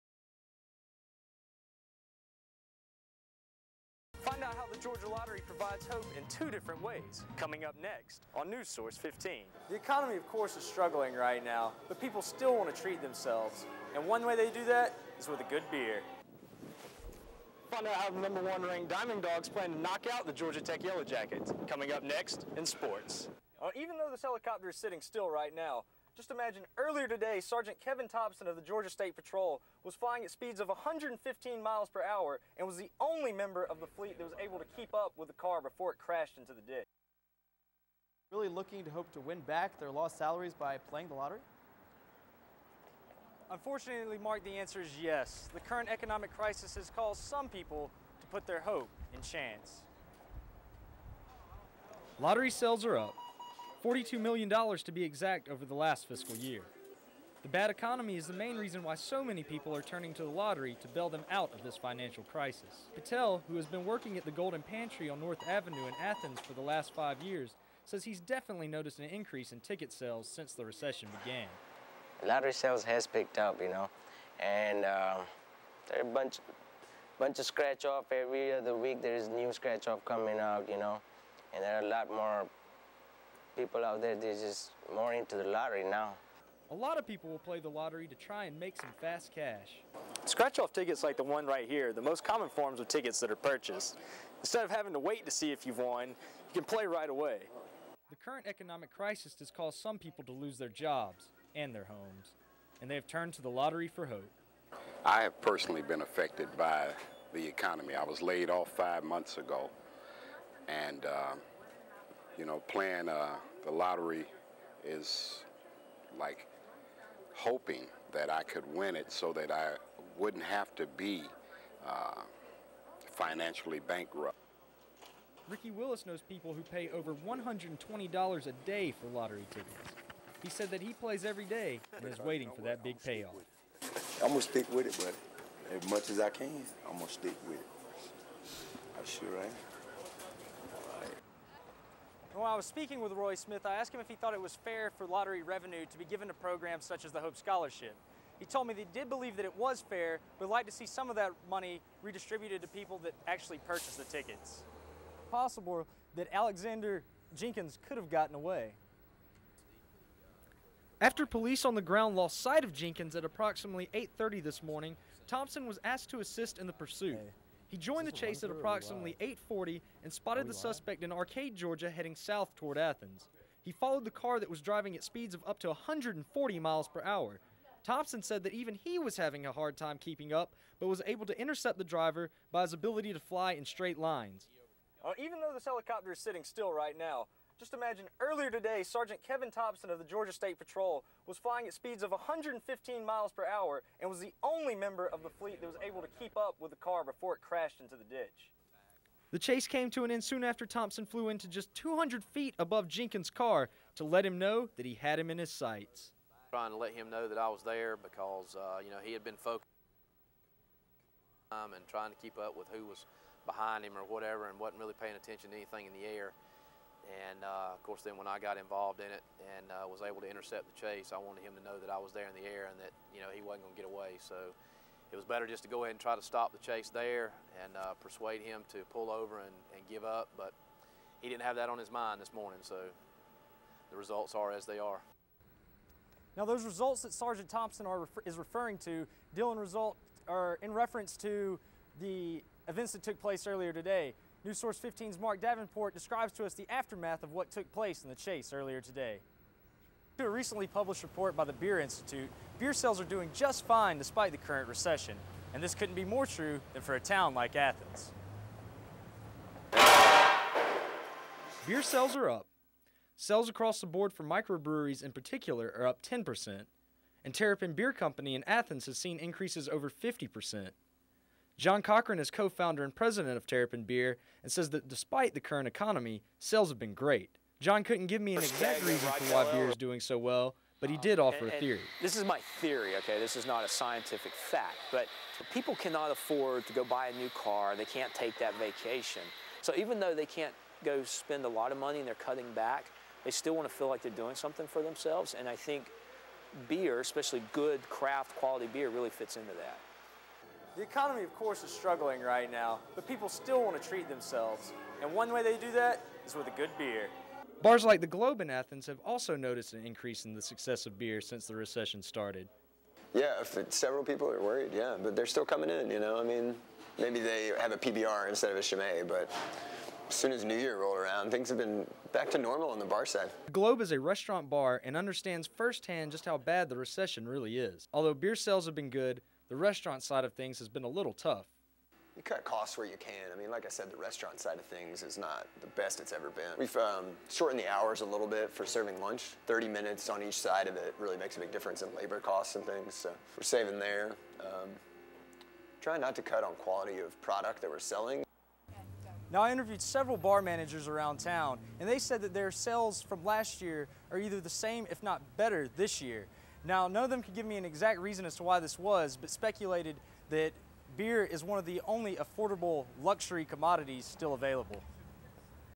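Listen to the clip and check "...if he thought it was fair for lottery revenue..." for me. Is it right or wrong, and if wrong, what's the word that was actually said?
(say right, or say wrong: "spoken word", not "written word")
right.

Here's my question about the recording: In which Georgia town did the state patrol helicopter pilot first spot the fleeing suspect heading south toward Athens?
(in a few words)
Arcade.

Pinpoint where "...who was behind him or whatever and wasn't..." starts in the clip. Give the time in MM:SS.
03:32.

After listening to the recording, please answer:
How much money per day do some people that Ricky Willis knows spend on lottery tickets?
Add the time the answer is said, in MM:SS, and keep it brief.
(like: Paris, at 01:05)
$120, at 02:07.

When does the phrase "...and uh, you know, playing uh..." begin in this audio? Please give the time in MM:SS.
01:50.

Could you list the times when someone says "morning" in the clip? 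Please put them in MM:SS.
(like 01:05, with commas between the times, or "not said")
02:44, 03:52.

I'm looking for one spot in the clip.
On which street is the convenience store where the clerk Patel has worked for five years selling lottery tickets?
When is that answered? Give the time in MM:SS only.
01:05.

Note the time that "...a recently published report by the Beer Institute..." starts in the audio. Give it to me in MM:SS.
04:10.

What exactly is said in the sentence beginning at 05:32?
You cut costs where you can.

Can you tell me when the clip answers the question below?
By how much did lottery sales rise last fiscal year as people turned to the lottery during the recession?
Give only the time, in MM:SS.
00:53.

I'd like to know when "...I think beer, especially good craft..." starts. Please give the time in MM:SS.
04:55.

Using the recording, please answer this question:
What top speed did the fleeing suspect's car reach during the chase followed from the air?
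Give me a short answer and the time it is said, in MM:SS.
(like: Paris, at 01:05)
140 miles per hour, at 02:55.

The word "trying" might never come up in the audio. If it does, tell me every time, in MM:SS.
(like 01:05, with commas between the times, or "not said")
03:26, 03:31, 05:45.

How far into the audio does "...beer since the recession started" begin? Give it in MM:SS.
05:10.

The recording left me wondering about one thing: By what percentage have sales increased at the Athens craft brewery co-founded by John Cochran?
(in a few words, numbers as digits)
over 50%.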